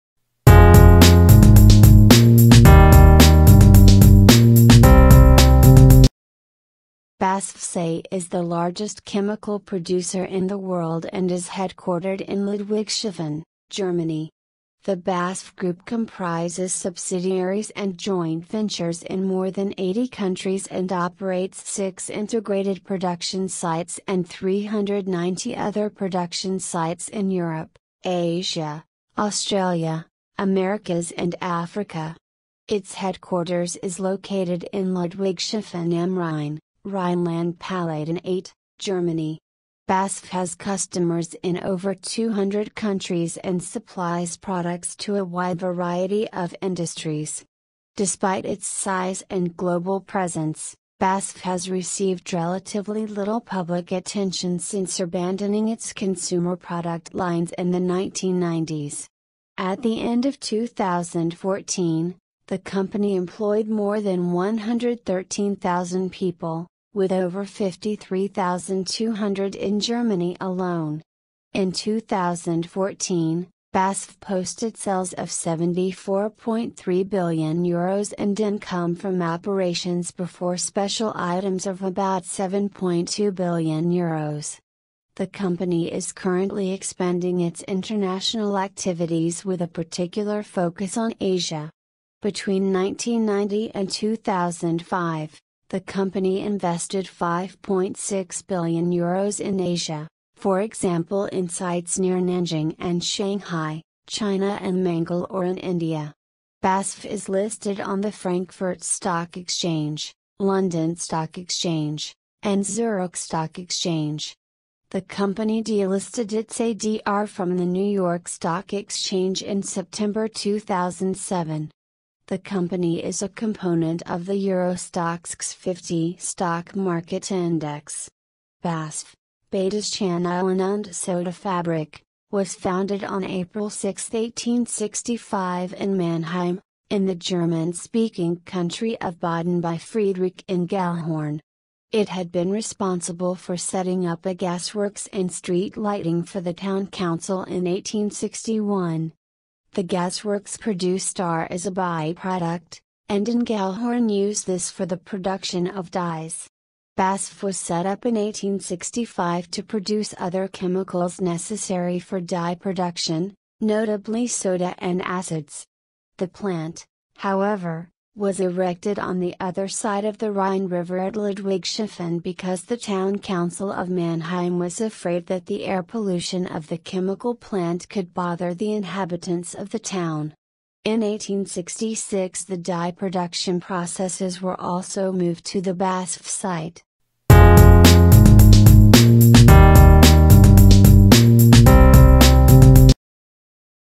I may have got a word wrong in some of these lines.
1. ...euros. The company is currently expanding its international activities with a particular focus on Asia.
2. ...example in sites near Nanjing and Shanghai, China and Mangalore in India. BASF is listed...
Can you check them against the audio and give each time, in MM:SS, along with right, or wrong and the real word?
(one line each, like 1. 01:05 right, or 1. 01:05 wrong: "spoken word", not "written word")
1. 01:23 right
2. 01:40 right.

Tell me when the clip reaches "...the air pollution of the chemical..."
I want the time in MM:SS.
02:55.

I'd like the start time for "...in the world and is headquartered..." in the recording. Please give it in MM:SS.
00:10.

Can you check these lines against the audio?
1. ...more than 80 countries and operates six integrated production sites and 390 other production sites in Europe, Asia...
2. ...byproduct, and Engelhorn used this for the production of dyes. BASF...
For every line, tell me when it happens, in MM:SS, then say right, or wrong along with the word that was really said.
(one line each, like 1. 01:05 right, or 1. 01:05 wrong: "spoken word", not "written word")
1. 00:19 right
2. 02:31 right.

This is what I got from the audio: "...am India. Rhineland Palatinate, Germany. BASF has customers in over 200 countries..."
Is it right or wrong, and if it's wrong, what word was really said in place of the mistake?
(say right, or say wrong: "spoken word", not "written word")
wrong: "Rhein", not "India".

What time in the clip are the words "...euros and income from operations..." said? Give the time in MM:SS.
01:17.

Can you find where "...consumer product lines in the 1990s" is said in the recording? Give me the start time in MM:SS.
00:55.